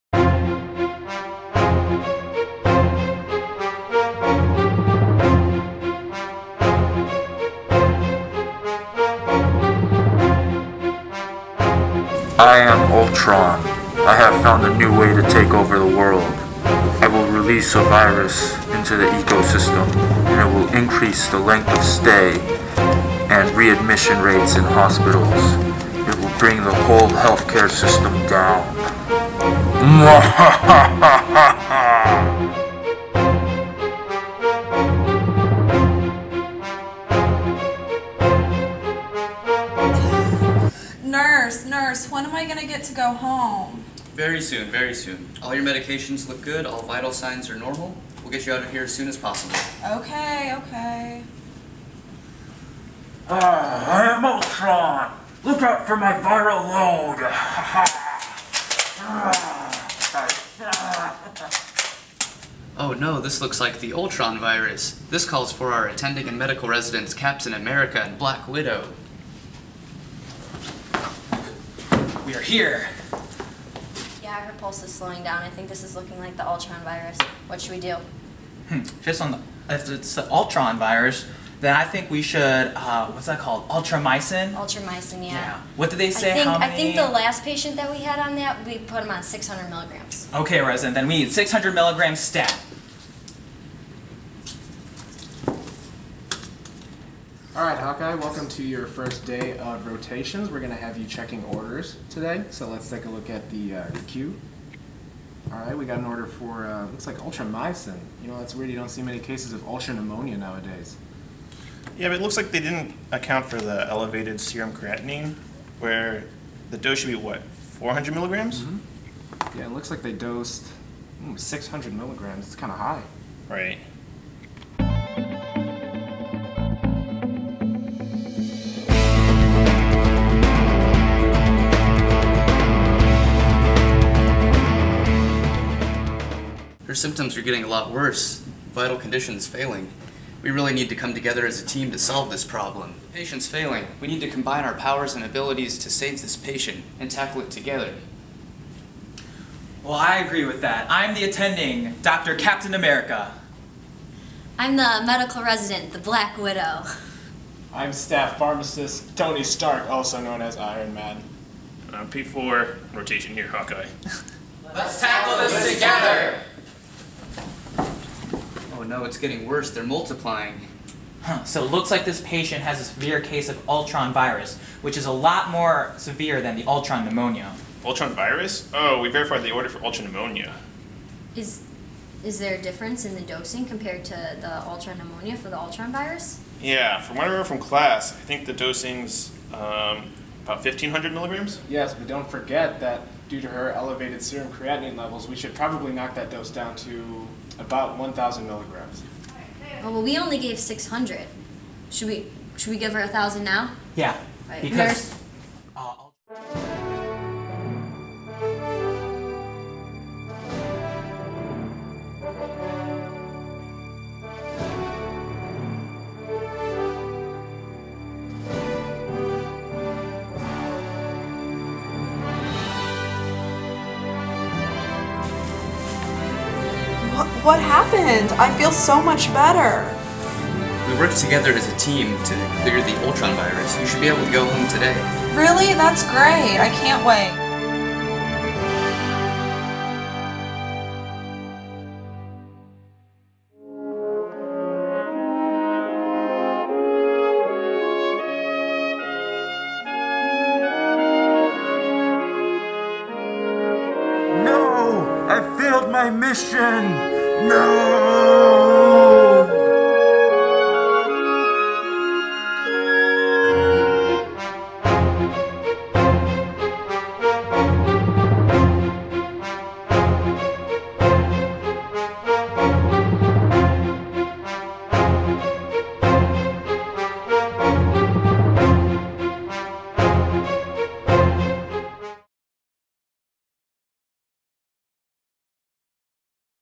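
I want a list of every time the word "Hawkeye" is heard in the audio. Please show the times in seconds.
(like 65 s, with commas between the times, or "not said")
97 s, 163 s.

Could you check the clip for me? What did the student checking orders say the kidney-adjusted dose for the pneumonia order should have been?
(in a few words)
400 milligrams.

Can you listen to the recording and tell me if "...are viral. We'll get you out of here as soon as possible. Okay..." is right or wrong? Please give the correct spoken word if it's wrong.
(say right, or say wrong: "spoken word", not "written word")
wrong: "normal", not "viral".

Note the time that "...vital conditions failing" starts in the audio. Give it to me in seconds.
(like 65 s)
138 s.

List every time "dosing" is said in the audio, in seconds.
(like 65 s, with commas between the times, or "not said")
183 s, 188 s.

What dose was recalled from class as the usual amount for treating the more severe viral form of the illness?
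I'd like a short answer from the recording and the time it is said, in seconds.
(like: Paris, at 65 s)
1,500 milligrams, at 190 s.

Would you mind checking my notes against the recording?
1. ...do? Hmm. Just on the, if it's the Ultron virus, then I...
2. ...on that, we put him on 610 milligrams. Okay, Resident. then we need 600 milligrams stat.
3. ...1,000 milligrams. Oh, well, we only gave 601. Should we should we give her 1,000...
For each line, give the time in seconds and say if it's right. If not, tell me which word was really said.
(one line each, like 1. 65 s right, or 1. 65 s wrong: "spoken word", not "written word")
1. 77 s right
2. 88 s wrong: "600", not "610"
3. 197 s wrong: "600", not "601".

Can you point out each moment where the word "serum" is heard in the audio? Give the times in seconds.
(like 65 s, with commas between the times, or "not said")
114 s, 194 s.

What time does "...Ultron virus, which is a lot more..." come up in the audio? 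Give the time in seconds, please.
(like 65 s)
173 s.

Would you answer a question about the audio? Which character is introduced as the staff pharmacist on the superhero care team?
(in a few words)
Tony Stark.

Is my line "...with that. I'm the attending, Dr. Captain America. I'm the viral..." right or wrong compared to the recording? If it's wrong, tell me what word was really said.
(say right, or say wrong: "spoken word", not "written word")
wrong: "medical", not "viral".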